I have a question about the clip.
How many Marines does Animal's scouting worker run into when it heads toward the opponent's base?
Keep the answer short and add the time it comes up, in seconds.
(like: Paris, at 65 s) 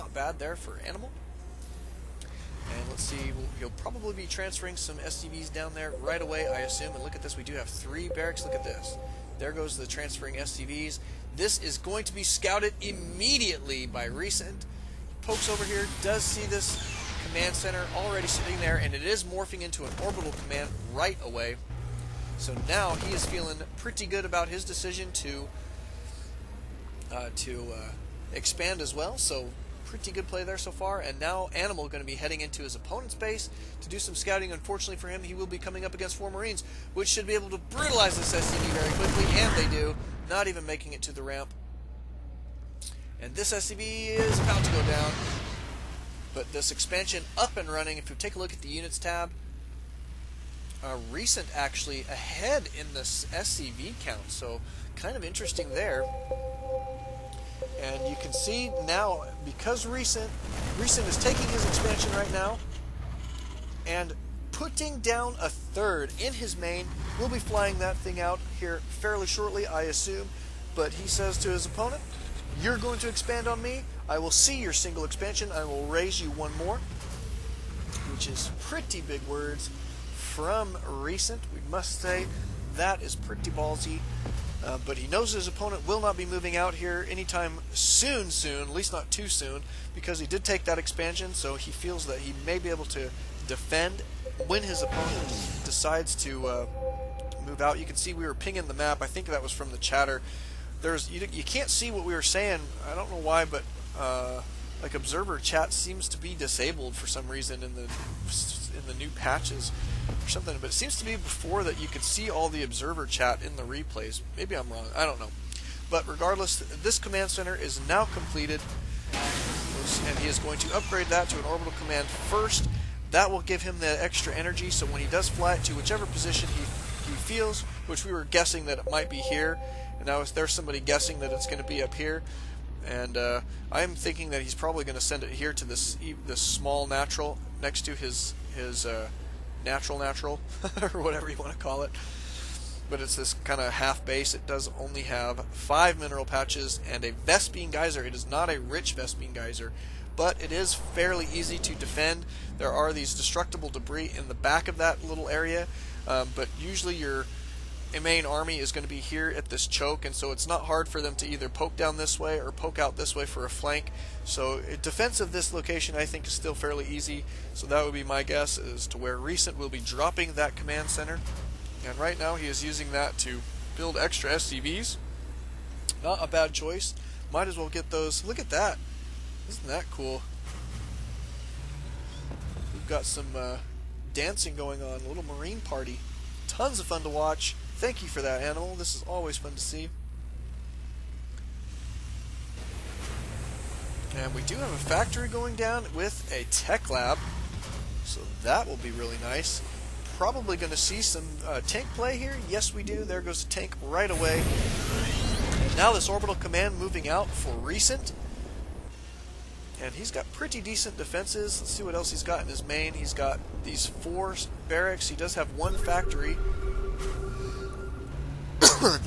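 4, at 36 s.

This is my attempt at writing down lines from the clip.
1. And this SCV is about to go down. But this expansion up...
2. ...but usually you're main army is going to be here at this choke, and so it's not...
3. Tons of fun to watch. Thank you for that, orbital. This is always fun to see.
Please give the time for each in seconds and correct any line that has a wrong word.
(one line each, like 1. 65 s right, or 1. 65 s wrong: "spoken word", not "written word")
1. 43 s right
2. 156 s right
3. 186 s wrong: "animal", not "orbital".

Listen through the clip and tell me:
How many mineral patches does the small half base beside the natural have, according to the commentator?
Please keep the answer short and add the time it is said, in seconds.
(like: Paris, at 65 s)
5, at 145 s.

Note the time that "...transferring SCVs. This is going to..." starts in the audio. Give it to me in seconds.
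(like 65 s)
9 s.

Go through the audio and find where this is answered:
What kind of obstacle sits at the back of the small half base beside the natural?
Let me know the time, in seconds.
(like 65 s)
153 s.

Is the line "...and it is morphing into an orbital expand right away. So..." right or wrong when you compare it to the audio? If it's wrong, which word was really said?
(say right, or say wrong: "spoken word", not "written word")
wrong: "command", not "expand".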